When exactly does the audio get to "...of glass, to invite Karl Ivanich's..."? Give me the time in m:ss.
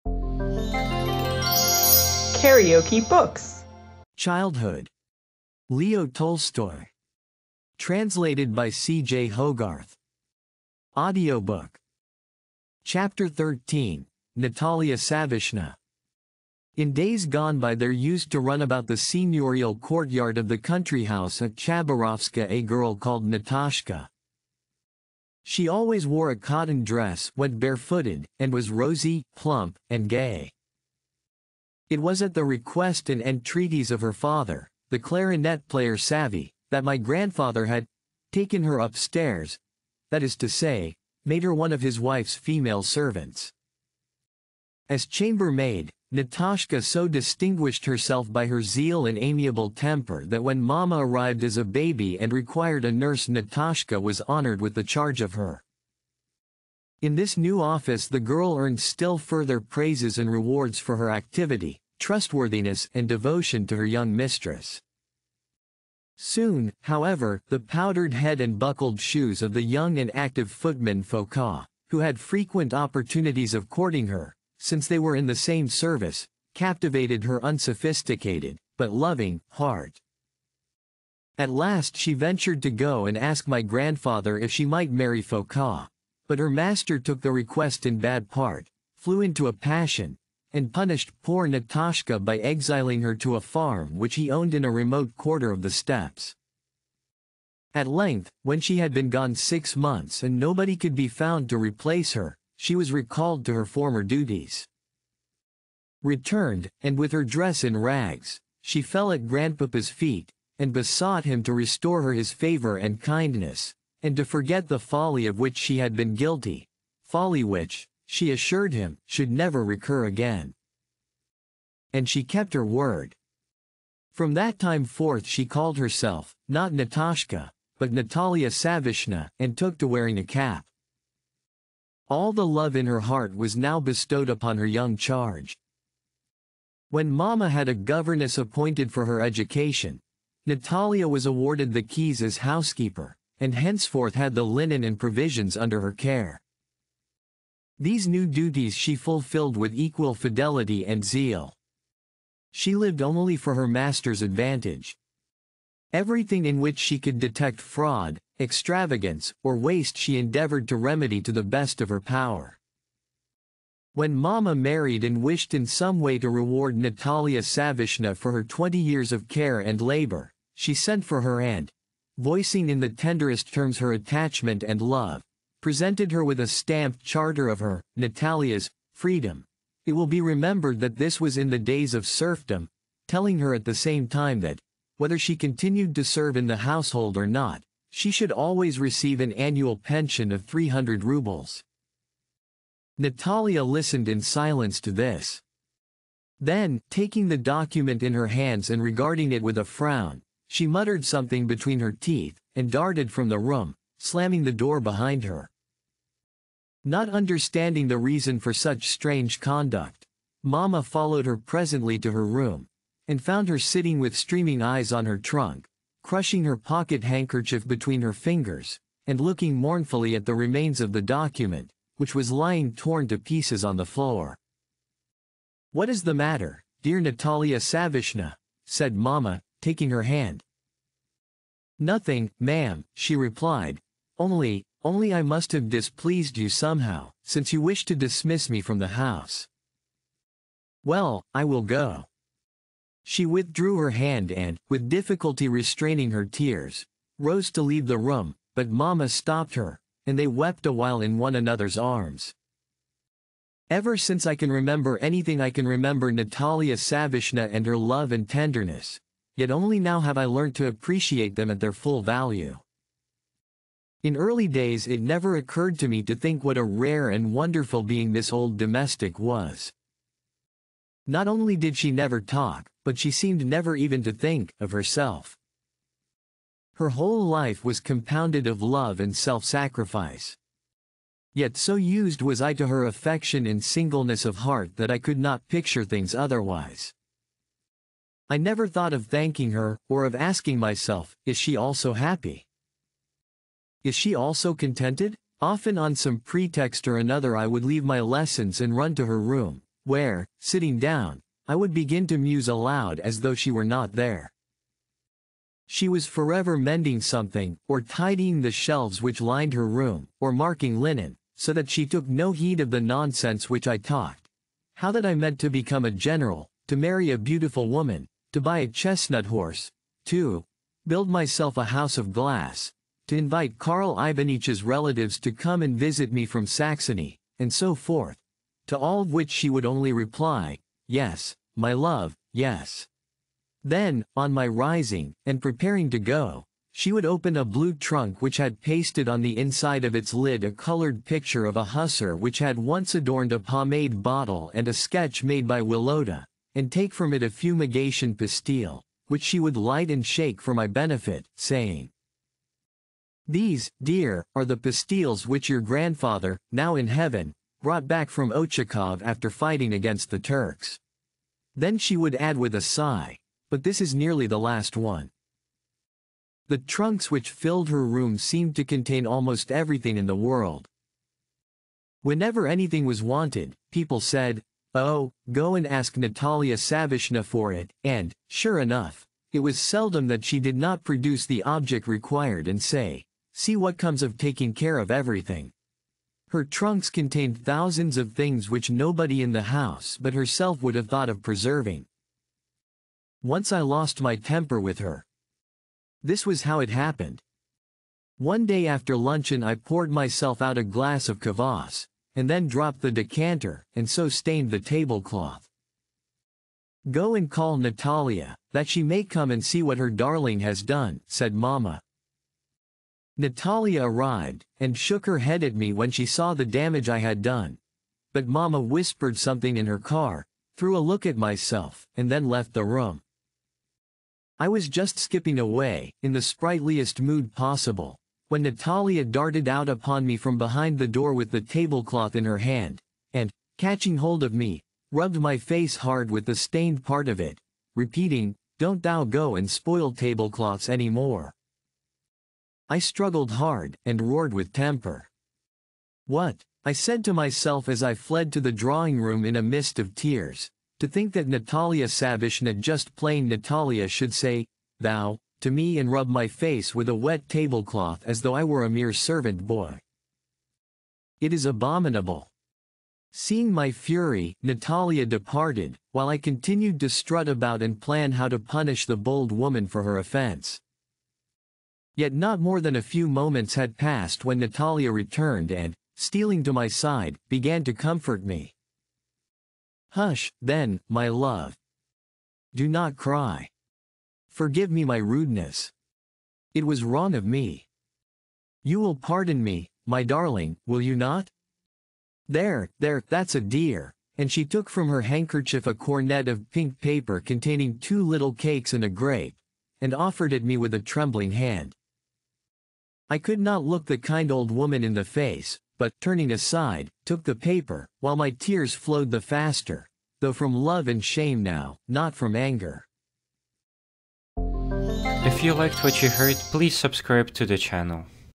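5:21.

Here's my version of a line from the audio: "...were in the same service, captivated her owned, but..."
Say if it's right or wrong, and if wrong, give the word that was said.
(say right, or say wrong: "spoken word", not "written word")
wrong: "unsophisticated", not "owned".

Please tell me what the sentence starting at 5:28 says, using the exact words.
To all of which she would only reply, Yes, my love, yes.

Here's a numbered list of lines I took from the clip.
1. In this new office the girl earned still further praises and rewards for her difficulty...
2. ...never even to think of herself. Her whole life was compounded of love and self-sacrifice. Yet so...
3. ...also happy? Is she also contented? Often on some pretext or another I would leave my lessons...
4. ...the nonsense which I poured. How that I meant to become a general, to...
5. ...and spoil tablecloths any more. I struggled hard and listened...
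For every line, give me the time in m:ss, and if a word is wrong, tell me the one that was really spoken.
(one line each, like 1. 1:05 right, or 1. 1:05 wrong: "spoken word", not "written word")
1. 0:57 wrong: "activity", not "difficulty"
2. 4:33 right
3. 4:51 right
4. 5:12 wrong: "talked", not "poured"
5. 7:19 wrong: "roared", not "listened".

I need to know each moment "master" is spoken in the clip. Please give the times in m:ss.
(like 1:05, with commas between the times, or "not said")
1:26, 2:33.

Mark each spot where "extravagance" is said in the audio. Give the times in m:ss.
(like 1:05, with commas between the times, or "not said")
2:38.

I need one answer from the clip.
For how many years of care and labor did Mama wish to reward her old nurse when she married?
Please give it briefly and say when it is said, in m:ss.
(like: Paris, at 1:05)
20, at 2:48.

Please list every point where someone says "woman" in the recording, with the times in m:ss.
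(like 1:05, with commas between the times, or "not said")
5:17, 7:49, 8:24.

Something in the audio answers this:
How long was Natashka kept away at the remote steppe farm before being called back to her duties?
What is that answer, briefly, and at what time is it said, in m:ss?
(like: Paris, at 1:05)
6 months, at 1:39.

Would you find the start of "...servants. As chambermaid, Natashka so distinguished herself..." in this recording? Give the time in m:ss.
0:42.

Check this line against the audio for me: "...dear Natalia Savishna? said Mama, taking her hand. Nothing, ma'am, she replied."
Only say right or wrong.
right.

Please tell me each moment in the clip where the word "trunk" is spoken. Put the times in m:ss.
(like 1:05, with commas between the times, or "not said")
3:35, 5:37, 6:06, 6:26.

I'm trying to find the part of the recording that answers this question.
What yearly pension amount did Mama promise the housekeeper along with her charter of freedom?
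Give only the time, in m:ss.
3:10.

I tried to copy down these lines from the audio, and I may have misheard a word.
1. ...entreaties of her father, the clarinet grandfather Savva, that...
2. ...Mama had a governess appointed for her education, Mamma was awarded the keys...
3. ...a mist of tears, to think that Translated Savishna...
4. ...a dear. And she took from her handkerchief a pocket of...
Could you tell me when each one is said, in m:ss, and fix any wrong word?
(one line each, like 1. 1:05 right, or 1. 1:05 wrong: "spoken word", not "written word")
1. 0:33 wrong: "player", not "grandfather"
2. 2:17 wrong: "Natalia", not "Mamma"
3. 7:29 wrong: "Natalia", not "Translated"
4. 8:13 wrong: "cornet", not "pocket".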